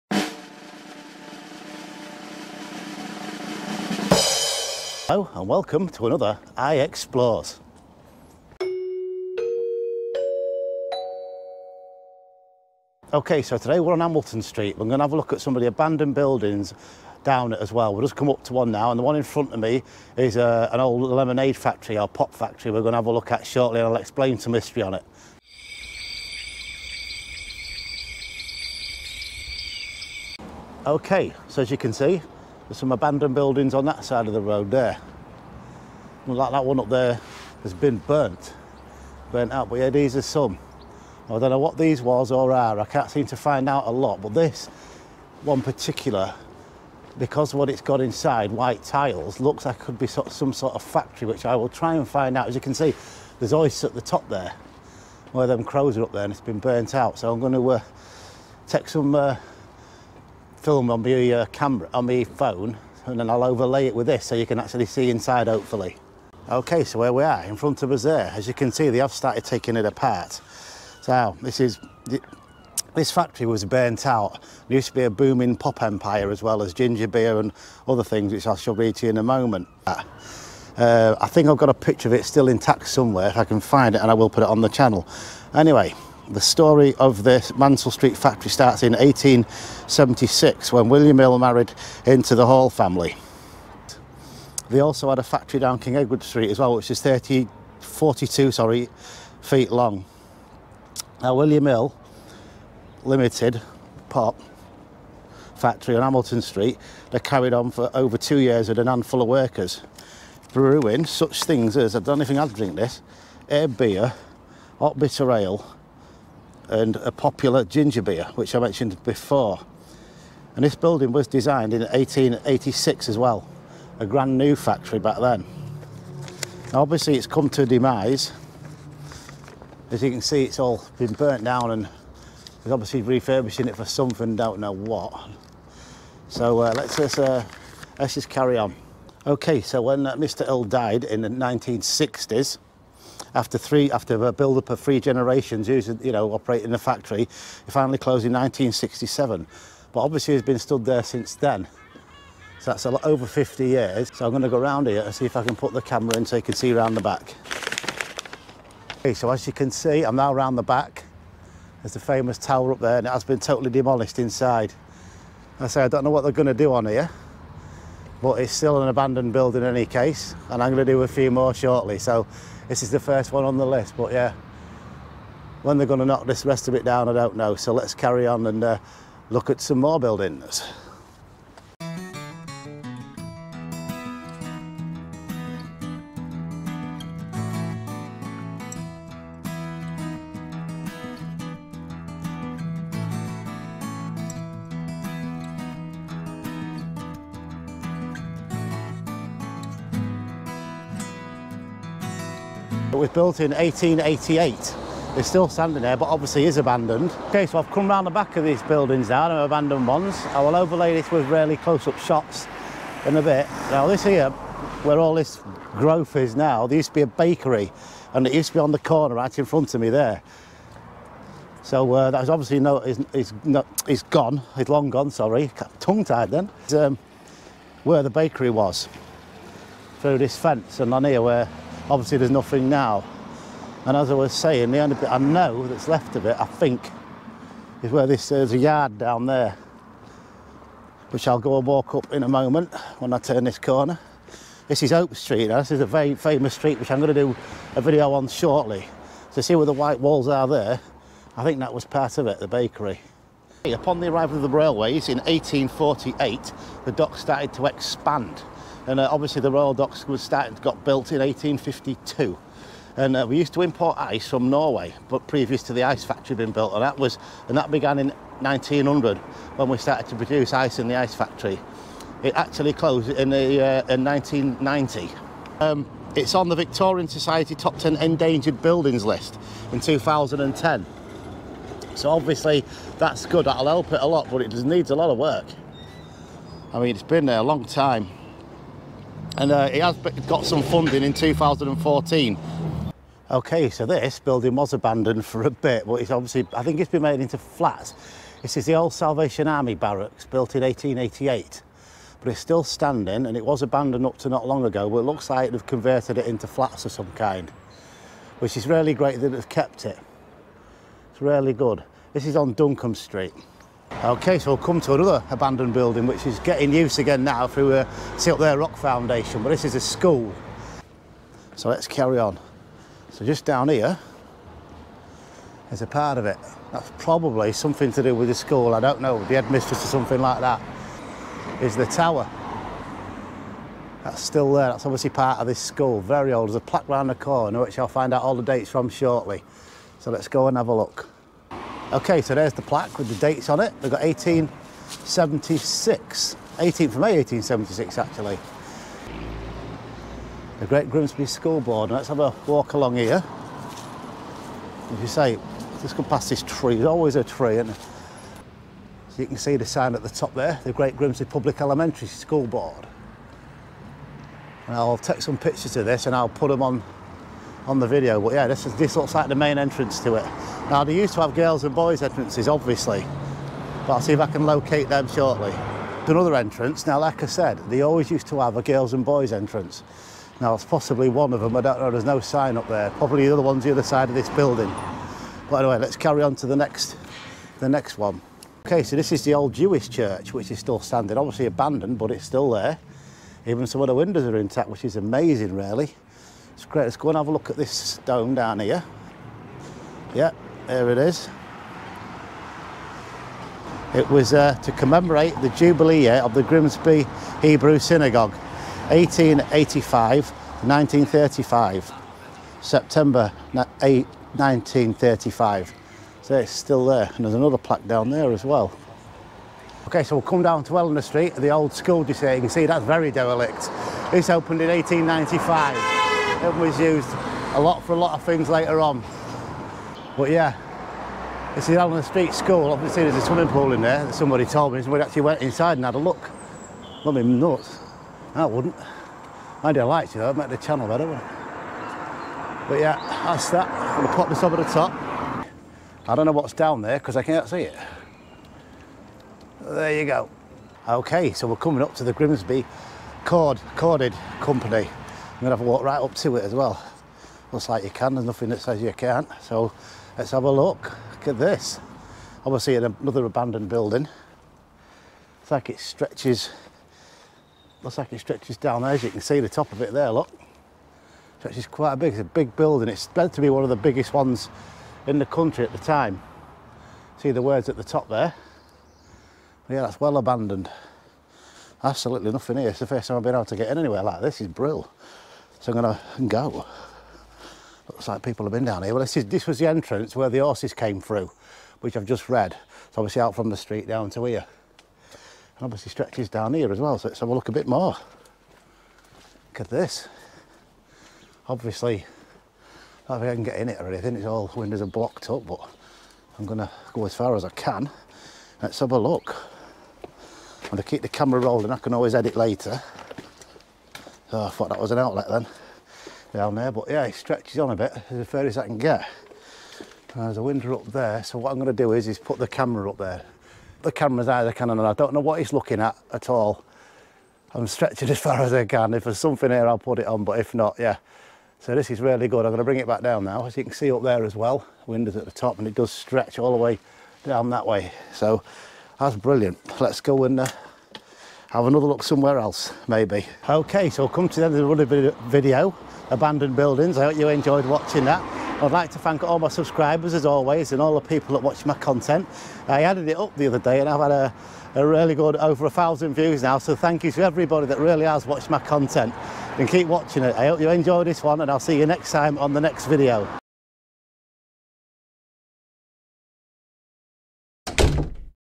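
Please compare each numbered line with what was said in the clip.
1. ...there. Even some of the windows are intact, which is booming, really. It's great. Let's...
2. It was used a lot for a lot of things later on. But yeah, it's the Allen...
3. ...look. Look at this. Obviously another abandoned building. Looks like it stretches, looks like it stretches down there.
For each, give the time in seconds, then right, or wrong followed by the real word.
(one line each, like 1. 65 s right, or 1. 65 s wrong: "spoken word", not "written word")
1. 392 s wrong: "amazing", not "booming"
2. 426 s right
3. 460 s right.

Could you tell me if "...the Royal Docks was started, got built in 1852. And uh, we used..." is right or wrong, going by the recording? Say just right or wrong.
right.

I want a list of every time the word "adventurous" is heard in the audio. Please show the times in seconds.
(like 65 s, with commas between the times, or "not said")
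not said.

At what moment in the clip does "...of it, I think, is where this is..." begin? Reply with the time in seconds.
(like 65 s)
236 s.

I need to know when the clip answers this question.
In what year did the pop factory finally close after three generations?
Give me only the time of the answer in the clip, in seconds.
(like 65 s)
148 s.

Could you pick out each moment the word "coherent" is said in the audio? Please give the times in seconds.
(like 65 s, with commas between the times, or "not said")
not said.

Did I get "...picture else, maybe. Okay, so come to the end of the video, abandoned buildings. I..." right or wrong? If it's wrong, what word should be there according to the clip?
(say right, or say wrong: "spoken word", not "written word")
wrong: "somewhere", not "picture".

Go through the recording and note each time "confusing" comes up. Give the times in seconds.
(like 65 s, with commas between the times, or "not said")
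not said.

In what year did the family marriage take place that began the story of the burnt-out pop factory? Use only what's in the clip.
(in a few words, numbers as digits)
1876.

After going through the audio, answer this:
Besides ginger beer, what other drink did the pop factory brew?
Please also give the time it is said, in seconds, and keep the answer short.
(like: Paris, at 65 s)
Hot bitter ale, at 114 s.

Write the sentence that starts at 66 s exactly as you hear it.
Okay, so where we are, in front of us there.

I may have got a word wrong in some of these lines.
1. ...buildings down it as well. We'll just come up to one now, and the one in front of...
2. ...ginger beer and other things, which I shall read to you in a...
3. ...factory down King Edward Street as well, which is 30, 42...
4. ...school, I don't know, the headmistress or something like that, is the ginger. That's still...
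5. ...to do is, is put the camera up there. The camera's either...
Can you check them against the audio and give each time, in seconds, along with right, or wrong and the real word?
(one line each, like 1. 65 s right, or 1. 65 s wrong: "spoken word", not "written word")
1. 16 s right
2. 76 s right
3. 95 s right
4. 328 s wrong: "tower", not "ginger"
5. 521 s right.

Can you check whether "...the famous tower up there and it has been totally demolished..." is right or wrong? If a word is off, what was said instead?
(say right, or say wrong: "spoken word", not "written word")
right.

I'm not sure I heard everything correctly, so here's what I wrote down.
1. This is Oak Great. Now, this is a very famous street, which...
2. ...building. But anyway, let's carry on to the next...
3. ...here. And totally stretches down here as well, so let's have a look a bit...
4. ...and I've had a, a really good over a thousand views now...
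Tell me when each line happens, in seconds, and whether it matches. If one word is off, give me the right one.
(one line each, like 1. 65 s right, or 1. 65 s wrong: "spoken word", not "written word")
1. 244 s wrong: "Street", not "Great"
2. 384 s right
3. 494 s wrong: "obviously", not "totally"
4. 553 s right.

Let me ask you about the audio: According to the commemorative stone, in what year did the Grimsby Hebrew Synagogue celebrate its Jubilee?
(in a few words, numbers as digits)
1935.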